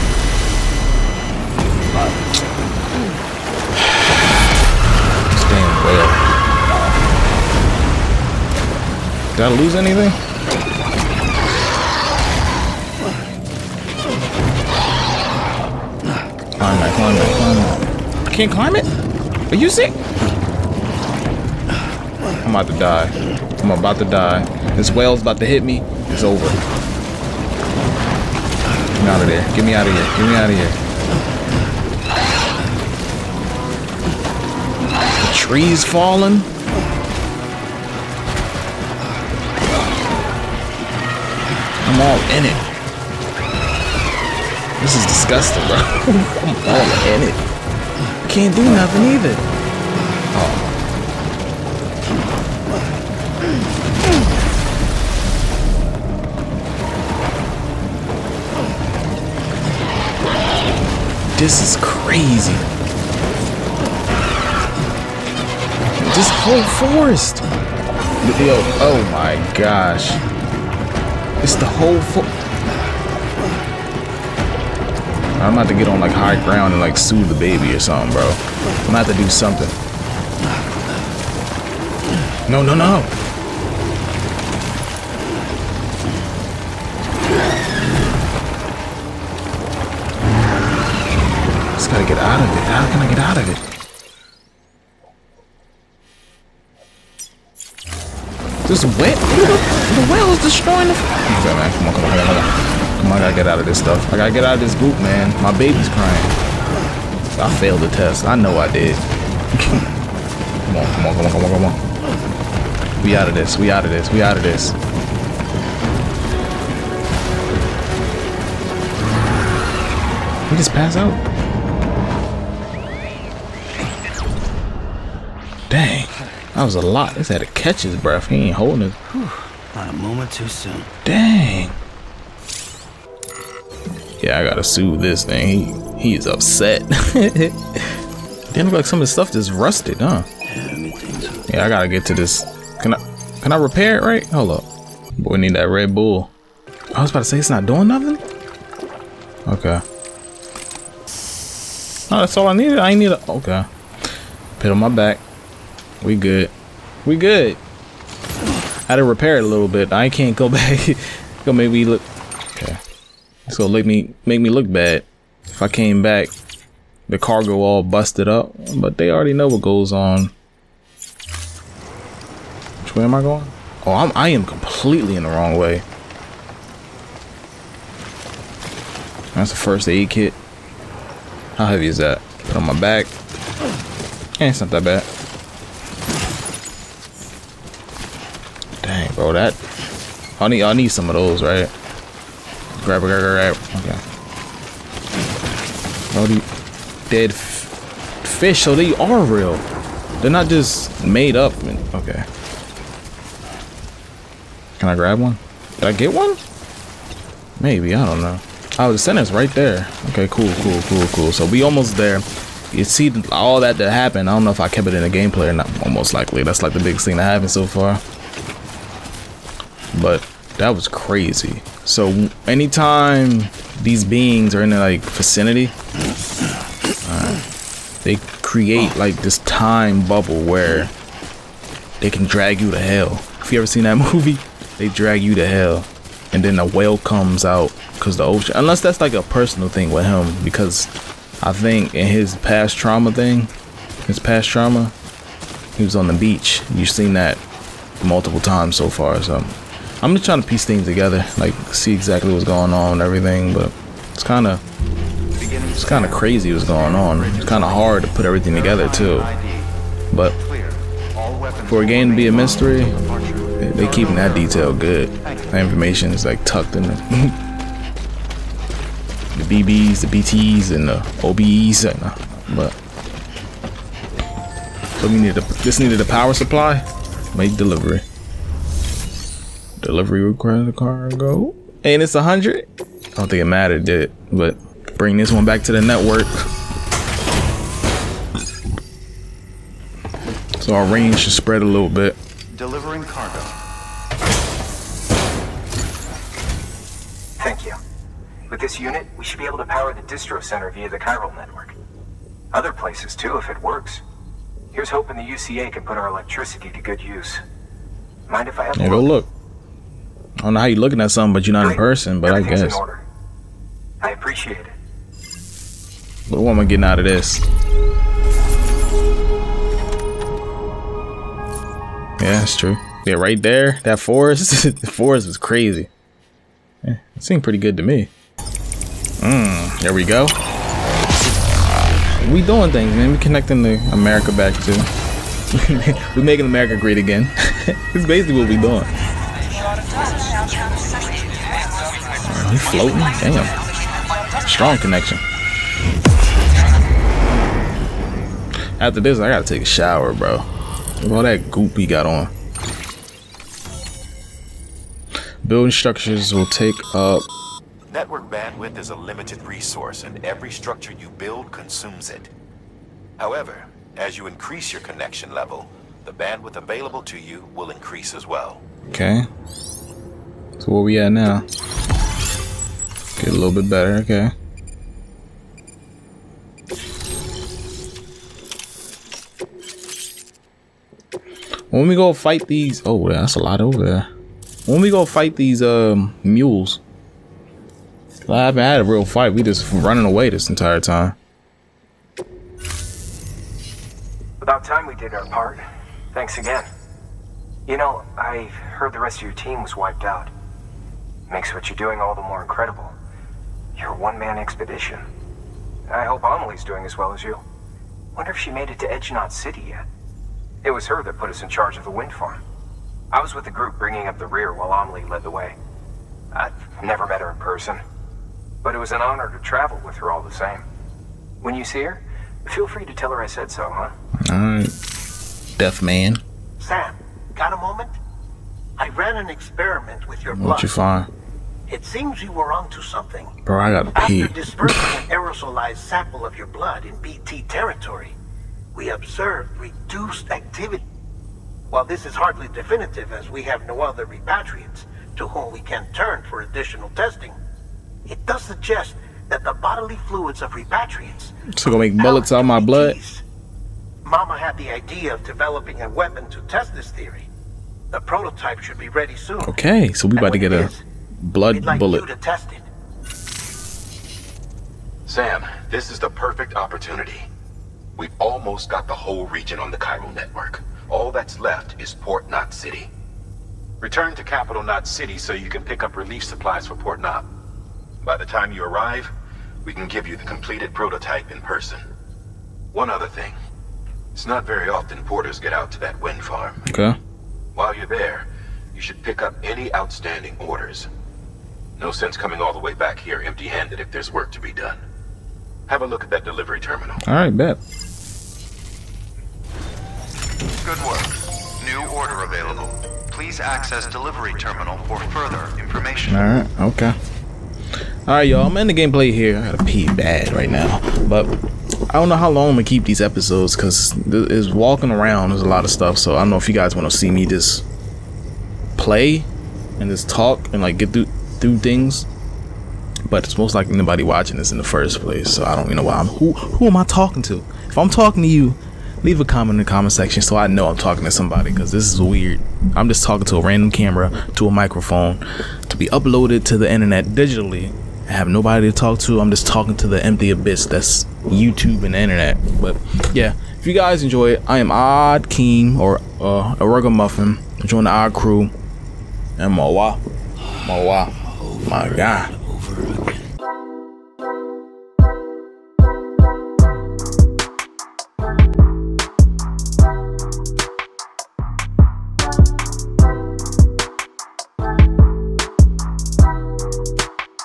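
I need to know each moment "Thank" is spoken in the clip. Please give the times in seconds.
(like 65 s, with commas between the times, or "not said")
297 s, 396 s.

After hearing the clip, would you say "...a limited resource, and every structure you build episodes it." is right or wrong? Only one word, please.
wrong.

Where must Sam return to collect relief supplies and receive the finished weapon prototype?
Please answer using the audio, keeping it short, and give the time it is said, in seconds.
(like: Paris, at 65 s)
Capital Knot City, at 474 s.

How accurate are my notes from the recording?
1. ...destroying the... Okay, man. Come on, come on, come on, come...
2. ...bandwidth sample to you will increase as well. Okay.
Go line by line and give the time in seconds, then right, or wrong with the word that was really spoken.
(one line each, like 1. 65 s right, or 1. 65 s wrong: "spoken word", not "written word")
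1. 100 s right
2. 366 s wrong: "available", not "sample".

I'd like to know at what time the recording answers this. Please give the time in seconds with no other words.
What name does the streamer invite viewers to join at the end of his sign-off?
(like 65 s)
547 s.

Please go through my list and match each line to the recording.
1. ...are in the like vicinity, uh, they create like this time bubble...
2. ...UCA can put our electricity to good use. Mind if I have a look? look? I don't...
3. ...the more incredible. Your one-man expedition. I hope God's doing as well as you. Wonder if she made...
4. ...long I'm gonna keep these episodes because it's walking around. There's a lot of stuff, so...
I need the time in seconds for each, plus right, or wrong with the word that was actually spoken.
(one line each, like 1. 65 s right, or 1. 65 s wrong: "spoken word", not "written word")
1. 224 s right
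2. 305 s right
3. 402 s wrong: "Amelie", not "God"
4. 512 s right.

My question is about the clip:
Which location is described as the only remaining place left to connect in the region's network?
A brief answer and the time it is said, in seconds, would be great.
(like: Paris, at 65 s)
Port Knot City, at 471 s.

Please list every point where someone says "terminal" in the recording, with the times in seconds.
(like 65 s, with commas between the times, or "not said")
496 s, 504 s.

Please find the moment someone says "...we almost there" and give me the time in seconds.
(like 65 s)
211 s.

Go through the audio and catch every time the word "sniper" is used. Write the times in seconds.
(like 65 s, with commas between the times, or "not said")
not said.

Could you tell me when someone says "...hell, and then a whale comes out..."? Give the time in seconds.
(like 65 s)
235 s.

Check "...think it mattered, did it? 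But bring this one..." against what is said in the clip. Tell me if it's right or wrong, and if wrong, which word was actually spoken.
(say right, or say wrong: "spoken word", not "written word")
right.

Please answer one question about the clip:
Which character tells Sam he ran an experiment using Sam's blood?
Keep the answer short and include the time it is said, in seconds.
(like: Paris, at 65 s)
Deadman, at 425 s.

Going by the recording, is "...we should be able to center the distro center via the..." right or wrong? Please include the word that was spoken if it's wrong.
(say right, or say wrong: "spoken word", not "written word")
wrong: "power", not "center".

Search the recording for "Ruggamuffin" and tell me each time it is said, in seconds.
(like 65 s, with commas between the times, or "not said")
546 s.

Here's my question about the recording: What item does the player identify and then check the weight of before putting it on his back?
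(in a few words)
first aid kit.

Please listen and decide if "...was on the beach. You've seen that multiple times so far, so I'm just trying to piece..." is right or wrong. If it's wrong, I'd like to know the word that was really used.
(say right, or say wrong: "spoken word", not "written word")
right.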